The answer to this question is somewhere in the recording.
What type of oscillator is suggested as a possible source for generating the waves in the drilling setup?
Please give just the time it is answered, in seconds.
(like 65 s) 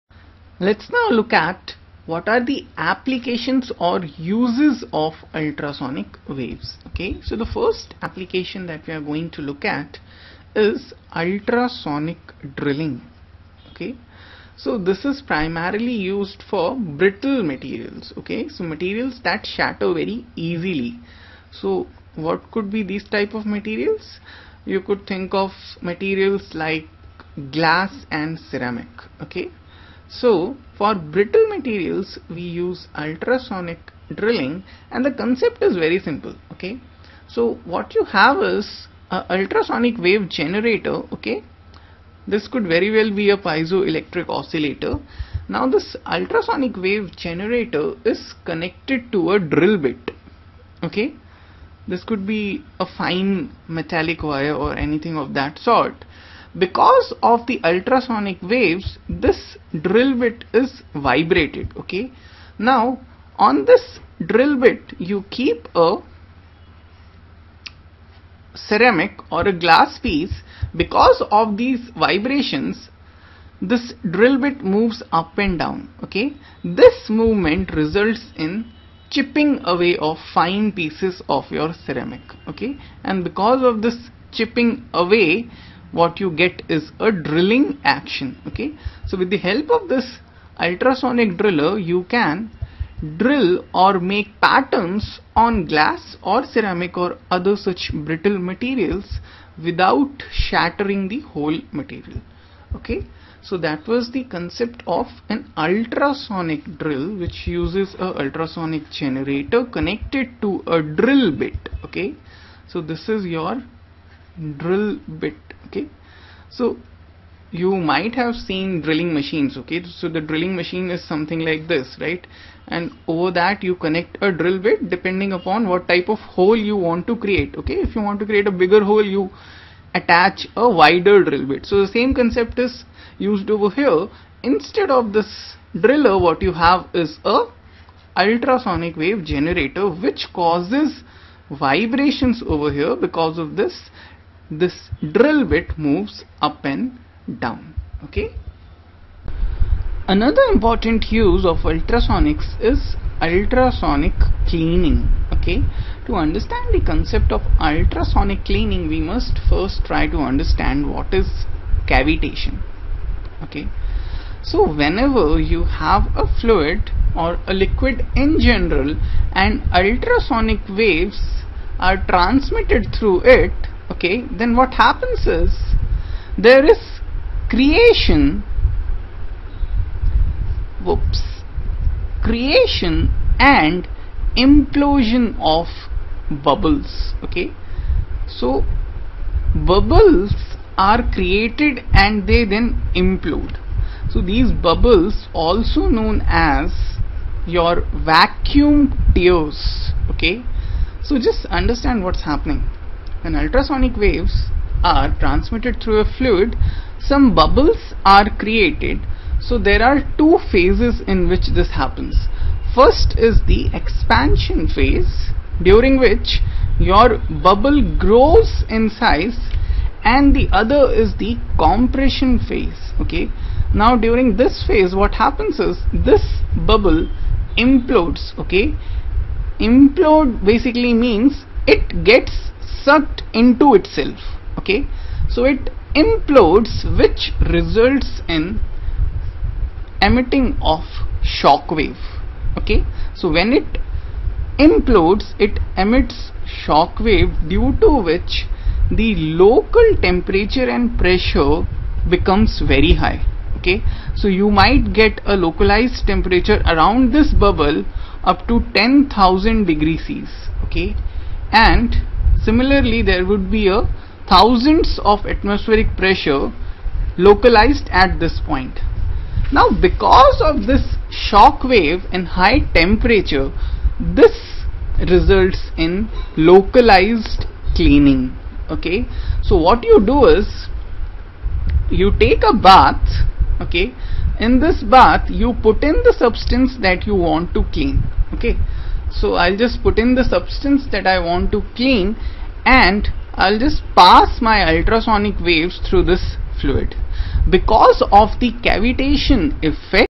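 43 s.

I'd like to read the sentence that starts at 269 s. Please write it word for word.
Now because of this shock wave and high temperature, this results in localized cleaning.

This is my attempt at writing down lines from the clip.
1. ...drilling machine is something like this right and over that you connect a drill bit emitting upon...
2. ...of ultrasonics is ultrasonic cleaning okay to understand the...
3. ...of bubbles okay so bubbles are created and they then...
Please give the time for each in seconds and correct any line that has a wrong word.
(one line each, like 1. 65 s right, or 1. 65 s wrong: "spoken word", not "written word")
1. 120 s wrong: "depending", not "emitting"
2. 151 s right
3. 185 s right.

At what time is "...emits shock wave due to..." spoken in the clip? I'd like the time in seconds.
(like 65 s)
245 s.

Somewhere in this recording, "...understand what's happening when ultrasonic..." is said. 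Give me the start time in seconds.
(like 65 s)
201 s.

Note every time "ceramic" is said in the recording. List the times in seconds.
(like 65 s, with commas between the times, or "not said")
28 s, 68 s, 81 s, 96 s.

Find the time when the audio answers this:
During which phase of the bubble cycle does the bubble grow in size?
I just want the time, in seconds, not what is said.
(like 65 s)
213 s.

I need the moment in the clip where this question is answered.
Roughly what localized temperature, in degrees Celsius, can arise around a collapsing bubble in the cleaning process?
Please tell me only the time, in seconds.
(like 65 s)
258 s.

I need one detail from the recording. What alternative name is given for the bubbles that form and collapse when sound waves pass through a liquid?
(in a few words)
vacuum tears.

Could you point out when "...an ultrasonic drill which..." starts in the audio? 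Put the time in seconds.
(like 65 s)
105 s.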